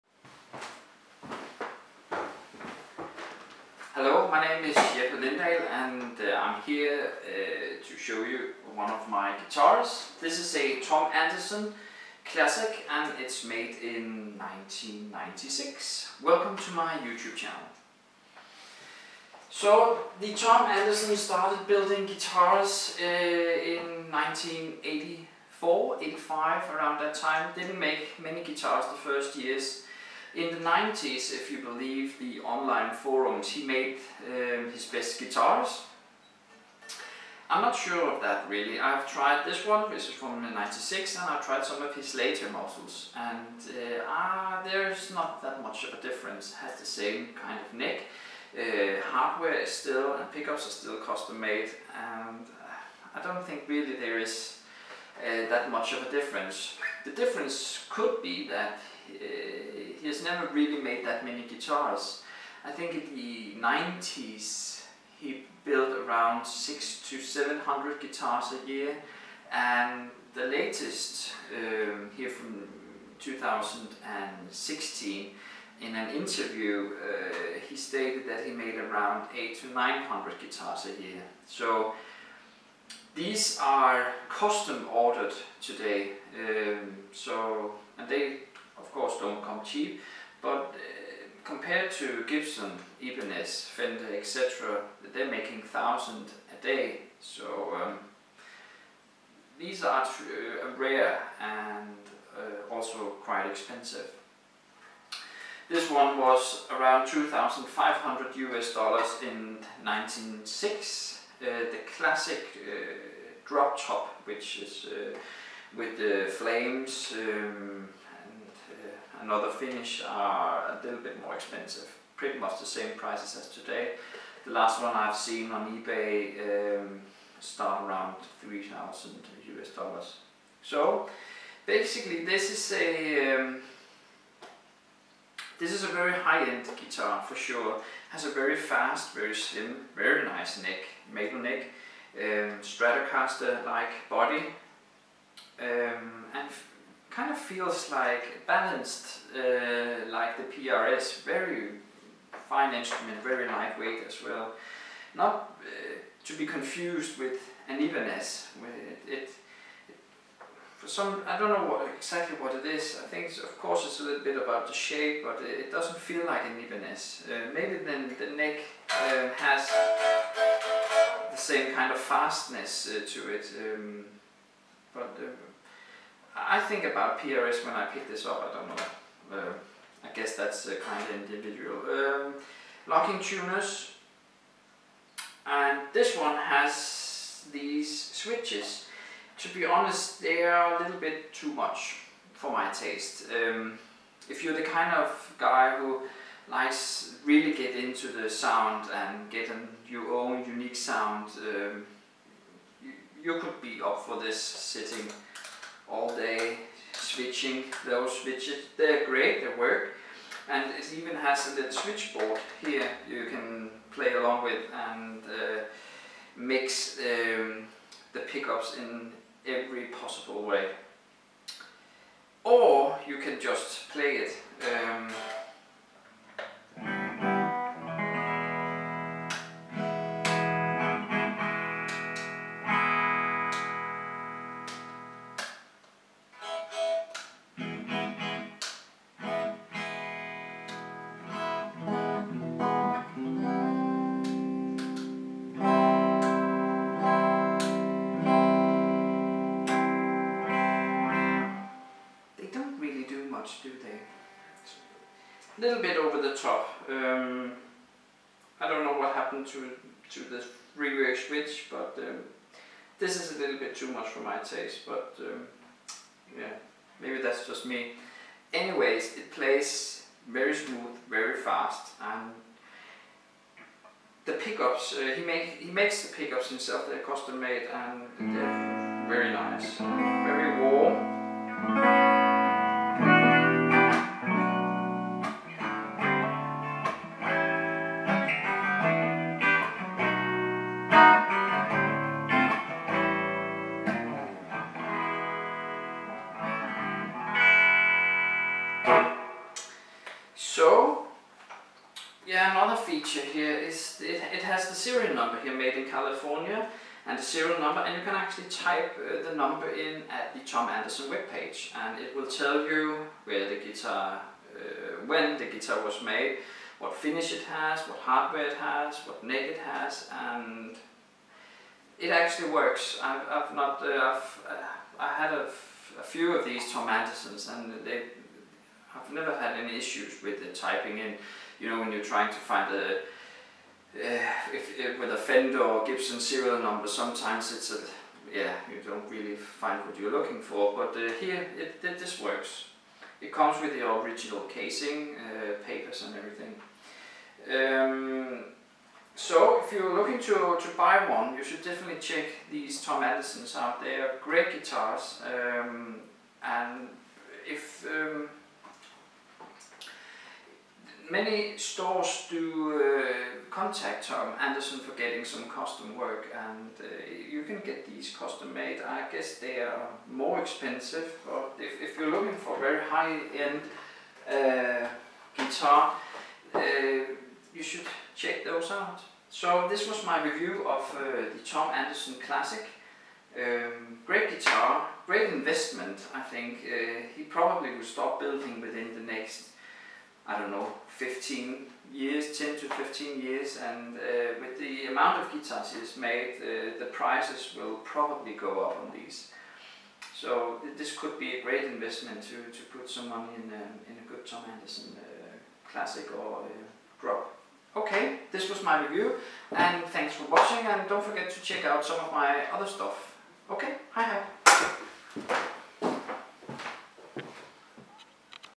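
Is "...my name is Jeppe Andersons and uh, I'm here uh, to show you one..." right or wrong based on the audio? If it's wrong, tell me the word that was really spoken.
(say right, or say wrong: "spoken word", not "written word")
wrong: "Lindahl", not "Andersons".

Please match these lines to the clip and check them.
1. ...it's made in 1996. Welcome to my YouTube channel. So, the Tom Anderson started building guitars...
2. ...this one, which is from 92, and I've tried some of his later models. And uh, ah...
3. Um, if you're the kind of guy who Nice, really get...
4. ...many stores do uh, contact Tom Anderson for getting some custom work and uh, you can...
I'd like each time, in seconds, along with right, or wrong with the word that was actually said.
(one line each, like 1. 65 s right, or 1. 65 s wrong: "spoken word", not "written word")
1. 13 s right
2. 39 s wrong: "96", not "92"
3. 193 s right
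4. 361 s right.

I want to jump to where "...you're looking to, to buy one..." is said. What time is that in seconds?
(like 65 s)
349 s.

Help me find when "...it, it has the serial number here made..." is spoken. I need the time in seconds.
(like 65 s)
304 s.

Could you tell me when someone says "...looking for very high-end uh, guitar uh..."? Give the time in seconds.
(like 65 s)
372 s.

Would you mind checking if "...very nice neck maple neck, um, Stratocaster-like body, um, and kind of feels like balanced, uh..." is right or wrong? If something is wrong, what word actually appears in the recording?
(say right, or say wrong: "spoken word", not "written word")
right.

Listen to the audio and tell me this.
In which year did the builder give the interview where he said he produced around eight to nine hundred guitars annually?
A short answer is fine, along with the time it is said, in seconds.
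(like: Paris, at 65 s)
2016, at 73 s.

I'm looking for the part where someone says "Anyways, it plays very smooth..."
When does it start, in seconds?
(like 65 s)
268 s.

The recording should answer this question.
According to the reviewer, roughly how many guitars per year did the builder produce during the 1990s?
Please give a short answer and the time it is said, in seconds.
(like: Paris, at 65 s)
600 to 700, at 66 s.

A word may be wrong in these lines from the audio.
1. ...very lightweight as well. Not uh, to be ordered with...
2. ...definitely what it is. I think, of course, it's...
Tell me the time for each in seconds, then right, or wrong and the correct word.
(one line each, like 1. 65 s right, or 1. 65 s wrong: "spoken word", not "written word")
1. 153 s wrong: "confused", not "ordered"
2. 161 s wrong: "exactly", not "definitely".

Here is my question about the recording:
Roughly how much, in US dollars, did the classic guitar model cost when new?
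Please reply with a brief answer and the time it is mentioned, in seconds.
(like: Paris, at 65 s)
$2,500, at 107 s.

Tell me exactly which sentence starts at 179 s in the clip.
Uh, I guess that's uh, kind of individual.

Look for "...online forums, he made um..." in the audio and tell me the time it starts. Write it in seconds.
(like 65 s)
32 s.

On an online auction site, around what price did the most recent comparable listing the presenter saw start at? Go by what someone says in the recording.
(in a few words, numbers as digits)
$3,000.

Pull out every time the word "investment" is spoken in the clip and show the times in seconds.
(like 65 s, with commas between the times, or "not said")
385 s, 401 s.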